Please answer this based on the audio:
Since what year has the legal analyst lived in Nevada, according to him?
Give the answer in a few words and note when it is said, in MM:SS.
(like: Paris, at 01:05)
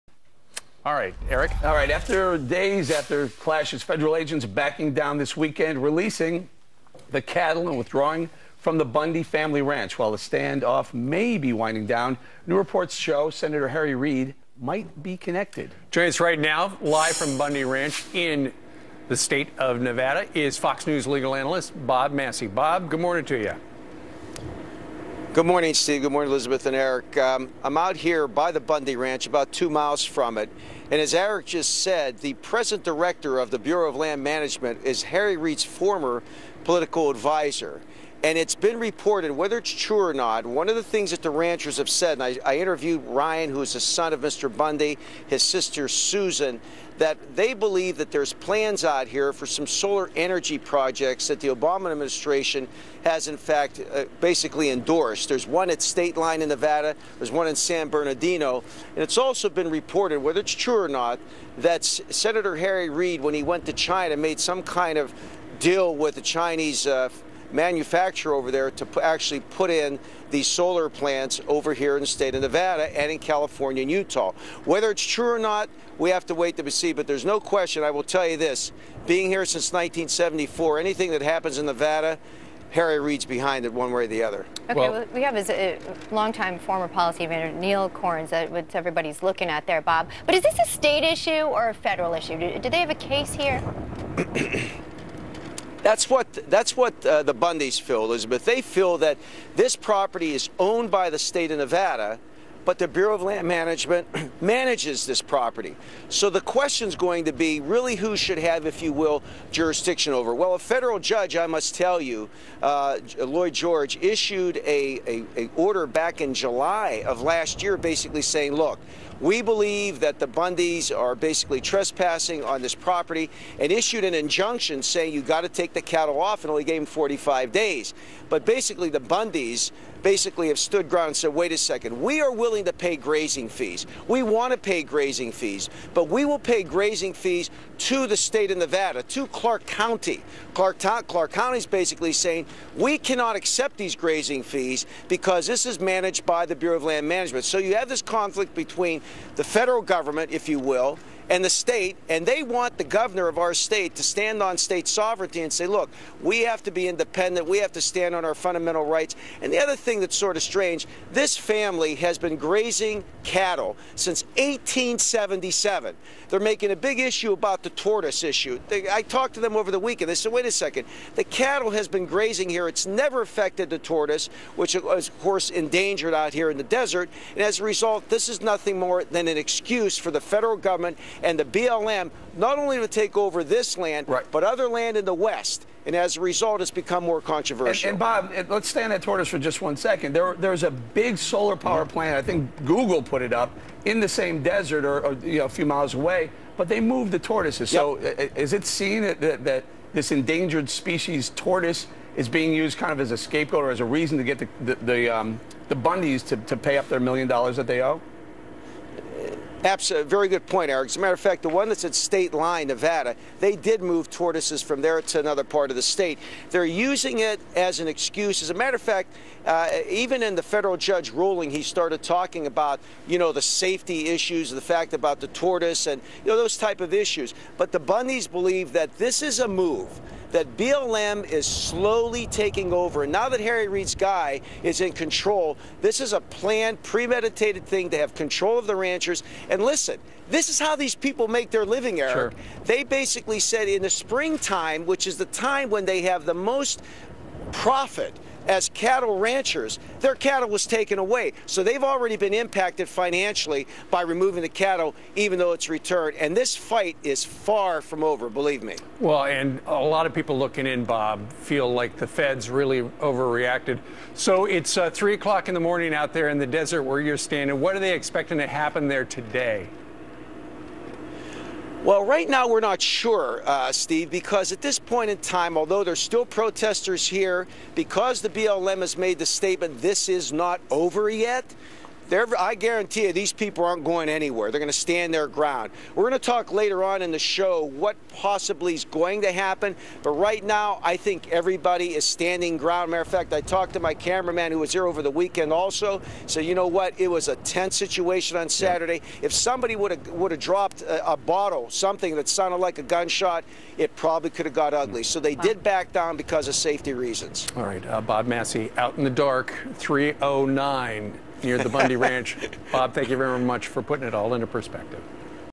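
1974, at 01:19.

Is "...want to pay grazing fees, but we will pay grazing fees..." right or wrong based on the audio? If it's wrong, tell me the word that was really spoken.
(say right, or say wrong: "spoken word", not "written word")
right.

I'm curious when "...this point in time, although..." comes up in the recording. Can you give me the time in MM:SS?
04:34.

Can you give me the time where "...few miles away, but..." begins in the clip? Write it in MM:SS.
03:15.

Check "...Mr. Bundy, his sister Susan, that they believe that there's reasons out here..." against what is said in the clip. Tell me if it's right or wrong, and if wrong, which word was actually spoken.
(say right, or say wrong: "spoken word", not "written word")
wrong: "plans", not "reasons".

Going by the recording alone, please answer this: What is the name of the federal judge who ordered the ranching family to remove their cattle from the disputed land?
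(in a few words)
Lloyd George.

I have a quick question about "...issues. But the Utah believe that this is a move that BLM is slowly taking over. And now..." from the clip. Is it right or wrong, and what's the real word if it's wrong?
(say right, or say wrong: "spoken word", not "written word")
wrong: "Bundys", not "Utah".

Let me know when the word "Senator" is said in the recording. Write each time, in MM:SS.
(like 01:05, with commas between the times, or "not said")
00:13, 01:02.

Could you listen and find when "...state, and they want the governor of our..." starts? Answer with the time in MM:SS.
02:31.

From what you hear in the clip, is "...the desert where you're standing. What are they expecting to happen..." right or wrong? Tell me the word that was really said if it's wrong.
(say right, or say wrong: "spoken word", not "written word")
right.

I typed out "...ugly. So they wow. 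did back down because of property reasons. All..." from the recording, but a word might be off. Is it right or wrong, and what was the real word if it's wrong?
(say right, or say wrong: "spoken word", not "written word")
wrong: "safety", not "property".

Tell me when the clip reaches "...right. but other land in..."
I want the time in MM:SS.
03:04.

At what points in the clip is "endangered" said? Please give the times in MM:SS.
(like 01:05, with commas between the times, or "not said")
02:55, 03:20.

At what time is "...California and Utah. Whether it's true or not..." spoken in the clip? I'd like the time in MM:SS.
01:13.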